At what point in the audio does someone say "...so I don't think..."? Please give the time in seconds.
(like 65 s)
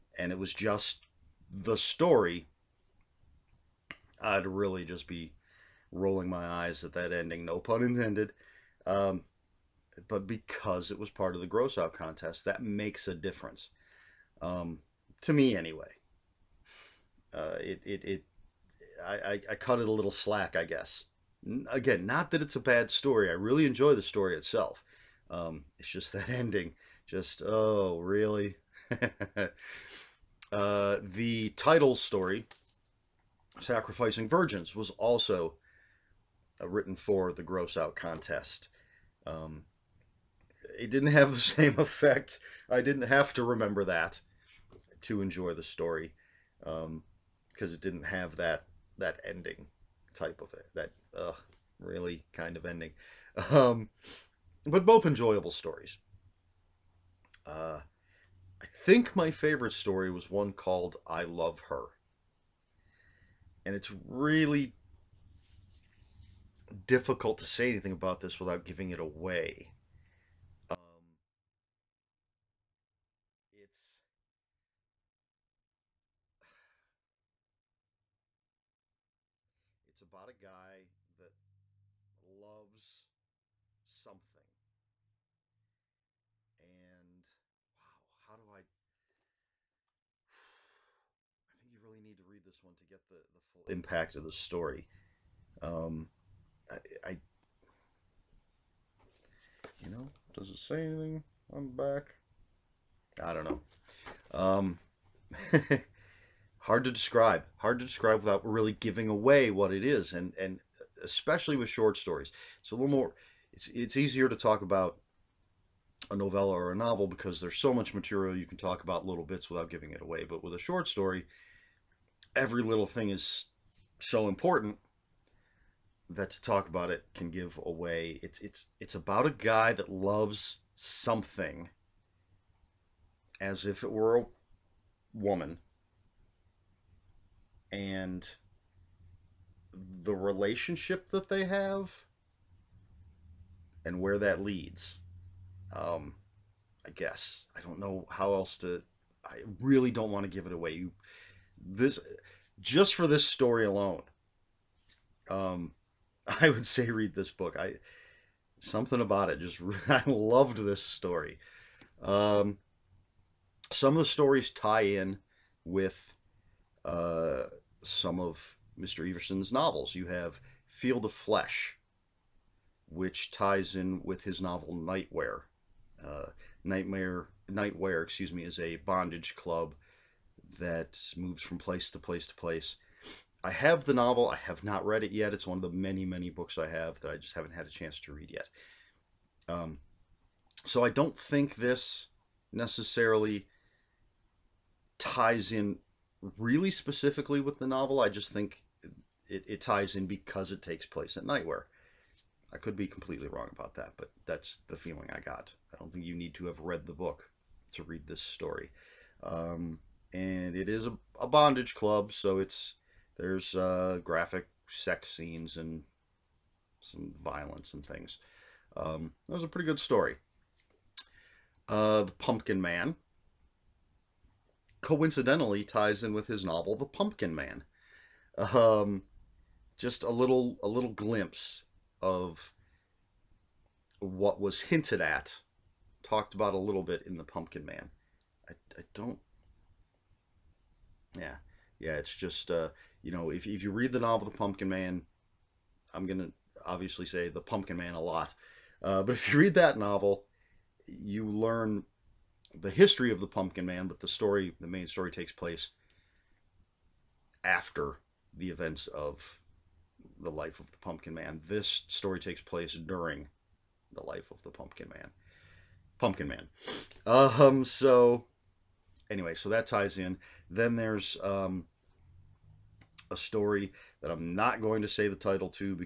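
190 s.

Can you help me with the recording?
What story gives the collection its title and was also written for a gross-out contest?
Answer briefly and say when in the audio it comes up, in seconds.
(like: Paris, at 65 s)
Sacrificing Virgins, at 33 s.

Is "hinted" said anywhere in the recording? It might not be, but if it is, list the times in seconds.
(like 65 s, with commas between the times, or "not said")
234 s.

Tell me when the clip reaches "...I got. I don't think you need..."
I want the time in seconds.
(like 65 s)
205 s.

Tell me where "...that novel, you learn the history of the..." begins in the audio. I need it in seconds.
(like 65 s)
249 s.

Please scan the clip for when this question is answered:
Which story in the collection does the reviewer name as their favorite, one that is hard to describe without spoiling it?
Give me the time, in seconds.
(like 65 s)
61 s.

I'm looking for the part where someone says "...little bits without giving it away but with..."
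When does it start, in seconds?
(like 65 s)
119 s.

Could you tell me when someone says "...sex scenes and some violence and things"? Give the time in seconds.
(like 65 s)
214 s.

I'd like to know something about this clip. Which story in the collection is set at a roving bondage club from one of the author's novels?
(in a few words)
Field of Flesh.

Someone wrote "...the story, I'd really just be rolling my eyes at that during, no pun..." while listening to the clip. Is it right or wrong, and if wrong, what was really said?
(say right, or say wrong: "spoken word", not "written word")
wrong: "ending", not "during".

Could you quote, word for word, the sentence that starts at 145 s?
Um, I guess I don't know how else to.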